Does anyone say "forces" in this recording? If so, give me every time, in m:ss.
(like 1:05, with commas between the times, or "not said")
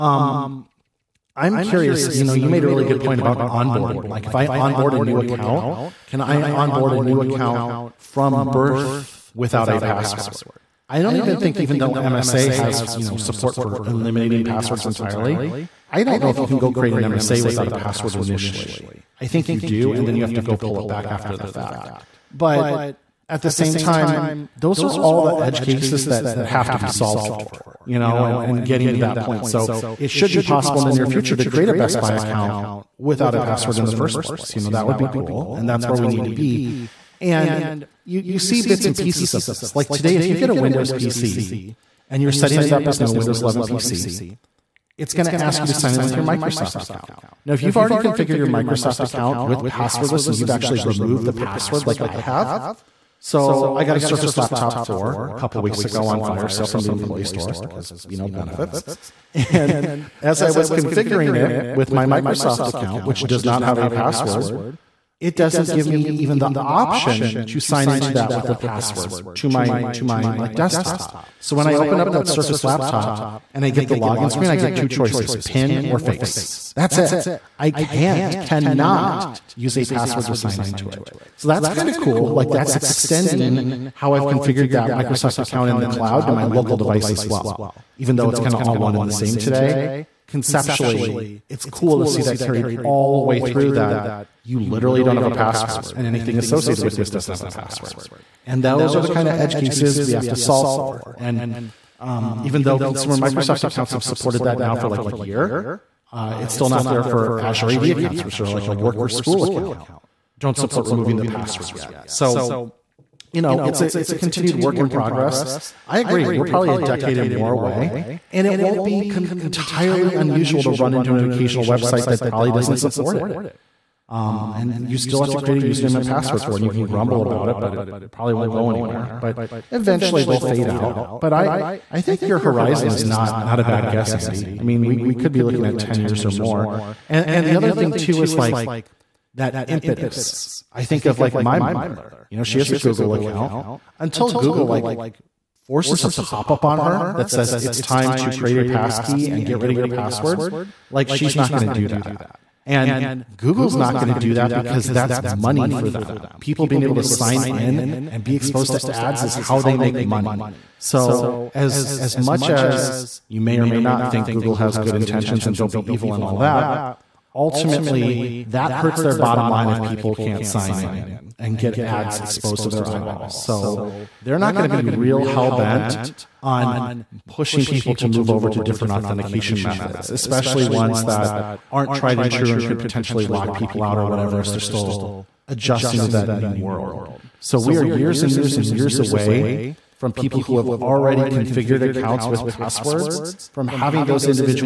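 2:25.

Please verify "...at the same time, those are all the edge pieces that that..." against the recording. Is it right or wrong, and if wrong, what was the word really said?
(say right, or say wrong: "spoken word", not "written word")
wrong: "cases", not "pieces".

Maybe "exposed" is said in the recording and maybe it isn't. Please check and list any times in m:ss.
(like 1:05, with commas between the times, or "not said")
2:38, 2:52.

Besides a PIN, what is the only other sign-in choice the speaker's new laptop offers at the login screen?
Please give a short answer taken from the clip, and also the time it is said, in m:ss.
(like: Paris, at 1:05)
Face, at 1:15.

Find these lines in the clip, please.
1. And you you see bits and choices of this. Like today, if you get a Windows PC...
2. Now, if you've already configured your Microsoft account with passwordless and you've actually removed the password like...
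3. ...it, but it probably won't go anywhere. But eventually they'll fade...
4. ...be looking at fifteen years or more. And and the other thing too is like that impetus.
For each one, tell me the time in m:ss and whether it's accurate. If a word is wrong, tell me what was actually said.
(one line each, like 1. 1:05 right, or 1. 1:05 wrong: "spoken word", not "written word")
1. 0:37 wrong: "pieces", not "choices"
2. 0:47 right
3. 2:07 right
4. 2:15 wrong: "ten", not "fifteen".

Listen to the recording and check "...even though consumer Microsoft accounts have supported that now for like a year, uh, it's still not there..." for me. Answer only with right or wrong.
right.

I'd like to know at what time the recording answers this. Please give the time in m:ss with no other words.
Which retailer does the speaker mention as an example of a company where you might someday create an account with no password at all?
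0:31.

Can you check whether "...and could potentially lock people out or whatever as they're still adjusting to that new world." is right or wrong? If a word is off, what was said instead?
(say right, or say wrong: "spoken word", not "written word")
right.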